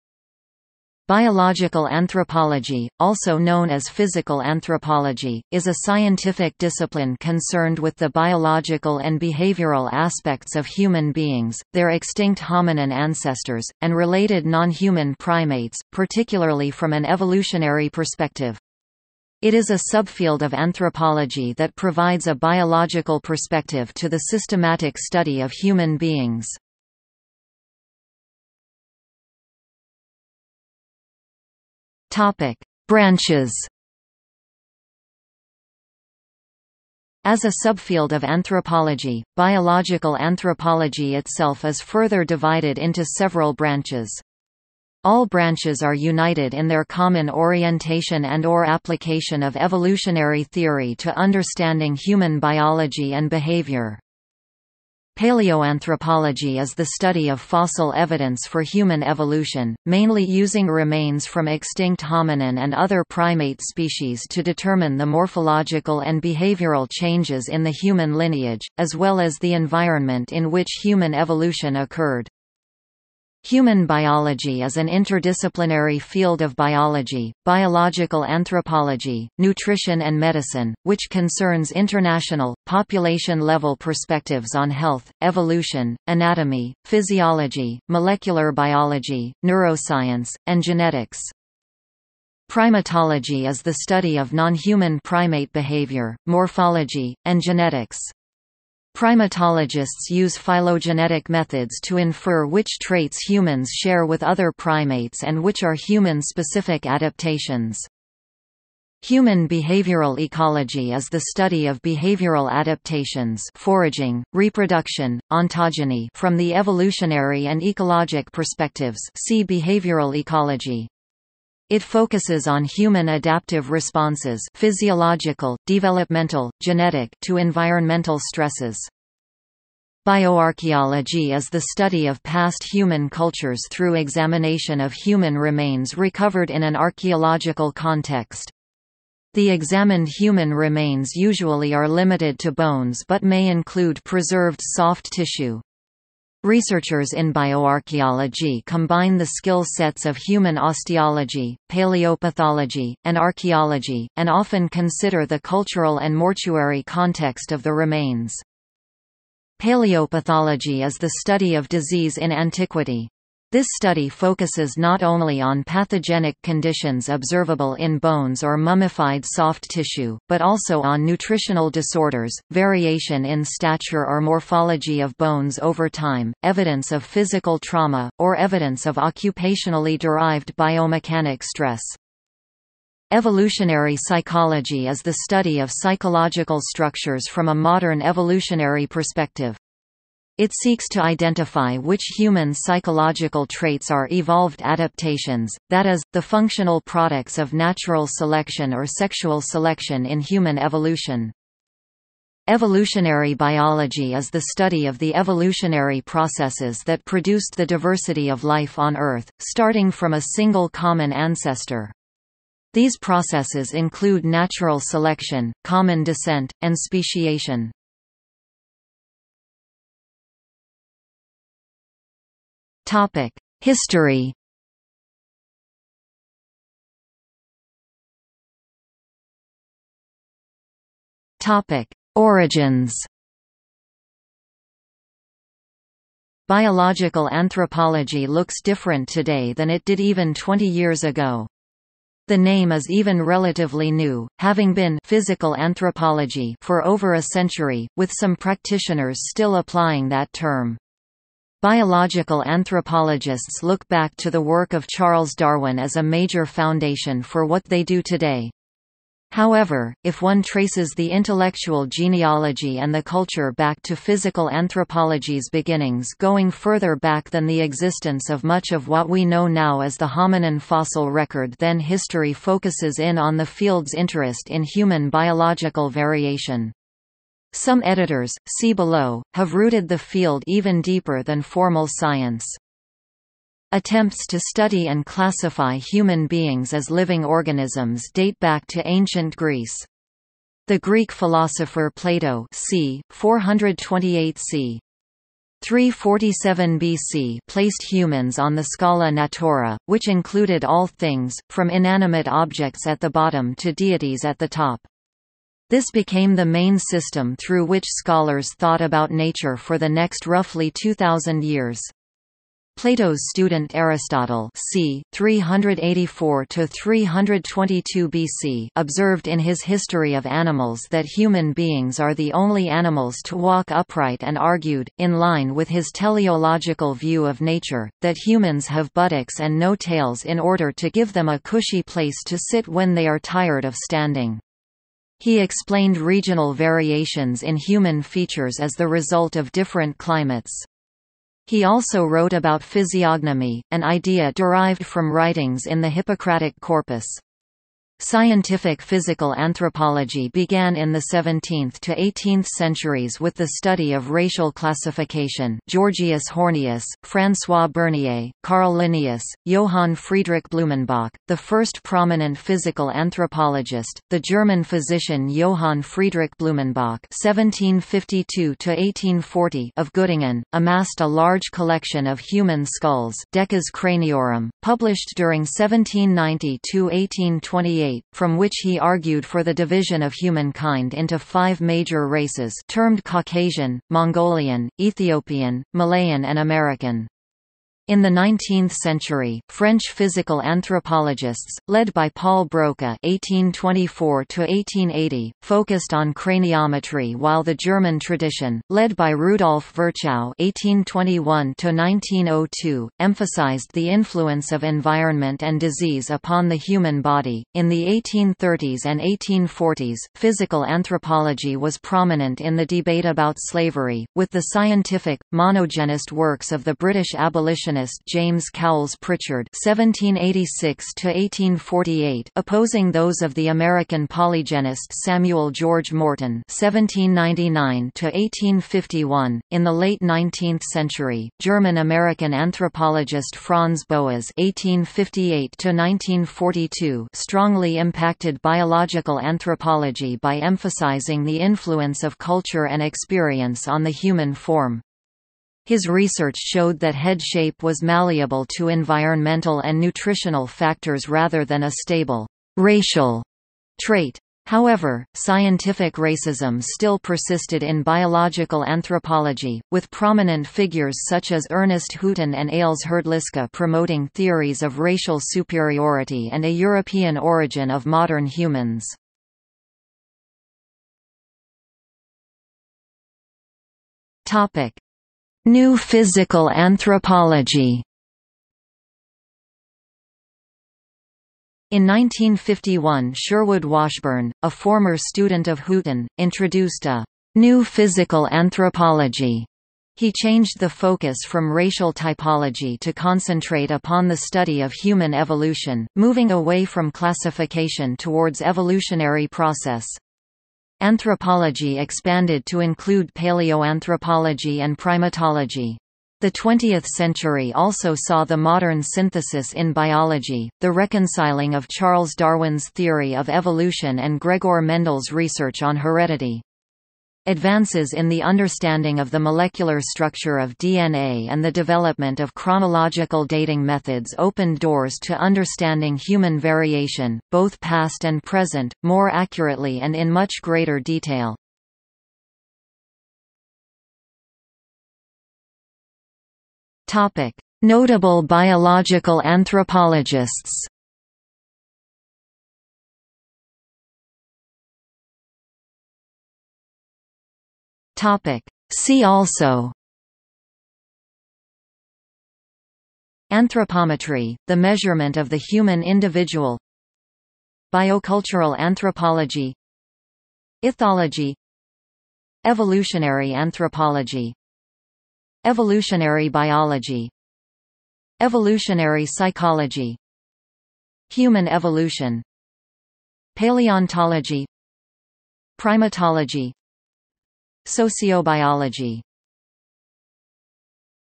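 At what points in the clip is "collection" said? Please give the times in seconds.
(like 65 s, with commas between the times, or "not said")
371 s.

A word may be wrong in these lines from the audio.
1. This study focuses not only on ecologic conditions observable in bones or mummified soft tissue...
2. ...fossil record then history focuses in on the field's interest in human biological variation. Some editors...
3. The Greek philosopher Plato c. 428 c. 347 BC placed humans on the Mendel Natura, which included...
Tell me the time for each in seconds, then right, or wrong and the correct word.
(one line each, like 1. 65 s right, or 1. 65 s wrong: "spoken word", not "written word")
1. 163 s wrong: "pathogenic", not "ecologic"
2. 270 s right
3. 290 s wrong: "Scala", not "Mendel".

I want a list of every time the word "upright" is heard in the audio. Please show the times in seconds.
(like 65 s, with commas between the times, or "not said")
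323 s.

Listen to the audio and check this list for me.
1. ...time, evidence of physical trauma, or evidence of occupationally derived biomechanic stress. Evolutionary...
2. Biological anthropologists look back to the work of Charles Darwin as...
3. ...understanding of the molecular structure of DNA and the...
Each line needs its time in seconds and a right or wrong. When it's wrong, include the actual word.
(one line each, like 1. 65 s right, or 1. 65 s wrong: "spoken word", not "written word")
1. 175 s right
2. 251 s right
3. 518 s right.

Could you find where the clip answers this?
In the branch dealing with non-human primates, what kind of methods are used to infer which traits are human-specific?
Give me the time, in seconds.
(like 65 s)
100 s.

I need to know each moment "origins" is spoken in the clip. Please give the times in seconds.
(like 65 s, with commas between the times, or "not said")
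232 s, 467 s.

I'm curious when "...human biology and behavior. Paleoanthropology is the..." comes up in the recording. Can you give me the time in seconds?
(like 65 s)
51 s.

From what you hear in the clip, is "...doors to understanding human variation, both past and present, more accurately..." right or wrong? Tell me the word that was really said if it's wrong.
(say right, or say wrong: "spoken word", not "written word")
right.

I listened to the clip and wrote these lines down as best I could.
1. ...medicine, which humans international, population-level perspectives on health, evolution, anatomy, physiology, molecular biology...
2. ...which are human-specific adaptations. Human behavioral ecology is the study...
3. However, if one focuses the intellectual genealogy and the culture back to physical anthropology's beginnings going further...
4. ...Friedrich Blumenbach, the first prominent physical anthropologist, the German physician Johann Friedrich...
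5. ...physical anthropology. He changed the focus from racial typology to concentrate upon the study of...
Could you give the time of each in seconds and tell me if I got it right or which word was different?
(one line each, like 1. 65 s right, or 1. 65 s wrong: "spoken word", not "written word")
1. 80 s wrong: "concerns", not "humans"
2. 105 s right
3. 259 s wrong: "traces", not "focuses"
4. 359 s right
5. 487 s right.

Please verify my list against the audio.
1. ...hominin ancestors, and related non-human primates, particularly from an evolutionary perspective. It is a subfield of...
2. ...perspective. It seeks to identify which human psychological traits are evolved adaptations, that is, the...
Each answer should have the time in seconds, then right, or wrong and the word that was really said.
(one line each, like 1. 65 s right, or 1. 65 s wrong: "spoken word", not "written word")
1. 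12 s right
2. 188 s right.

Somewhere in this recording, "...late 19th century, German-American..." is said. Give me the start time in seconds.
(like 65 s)
429 s.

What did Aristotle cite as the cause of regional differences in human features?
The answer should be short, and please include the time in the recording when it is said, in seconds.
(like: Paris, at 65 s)
Different climates, at 339 s.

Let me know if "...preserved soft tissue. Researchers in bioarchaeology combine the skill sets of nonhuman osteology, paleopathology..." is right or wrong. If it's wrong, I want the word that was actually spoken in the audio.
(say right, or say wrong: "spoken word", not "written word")
wrong: "human", not "nonhuman".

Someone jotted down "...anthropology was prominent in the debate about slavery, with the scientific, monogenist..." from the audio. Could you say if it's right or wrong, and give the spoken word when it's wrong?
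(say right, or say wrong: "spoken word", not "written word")
right.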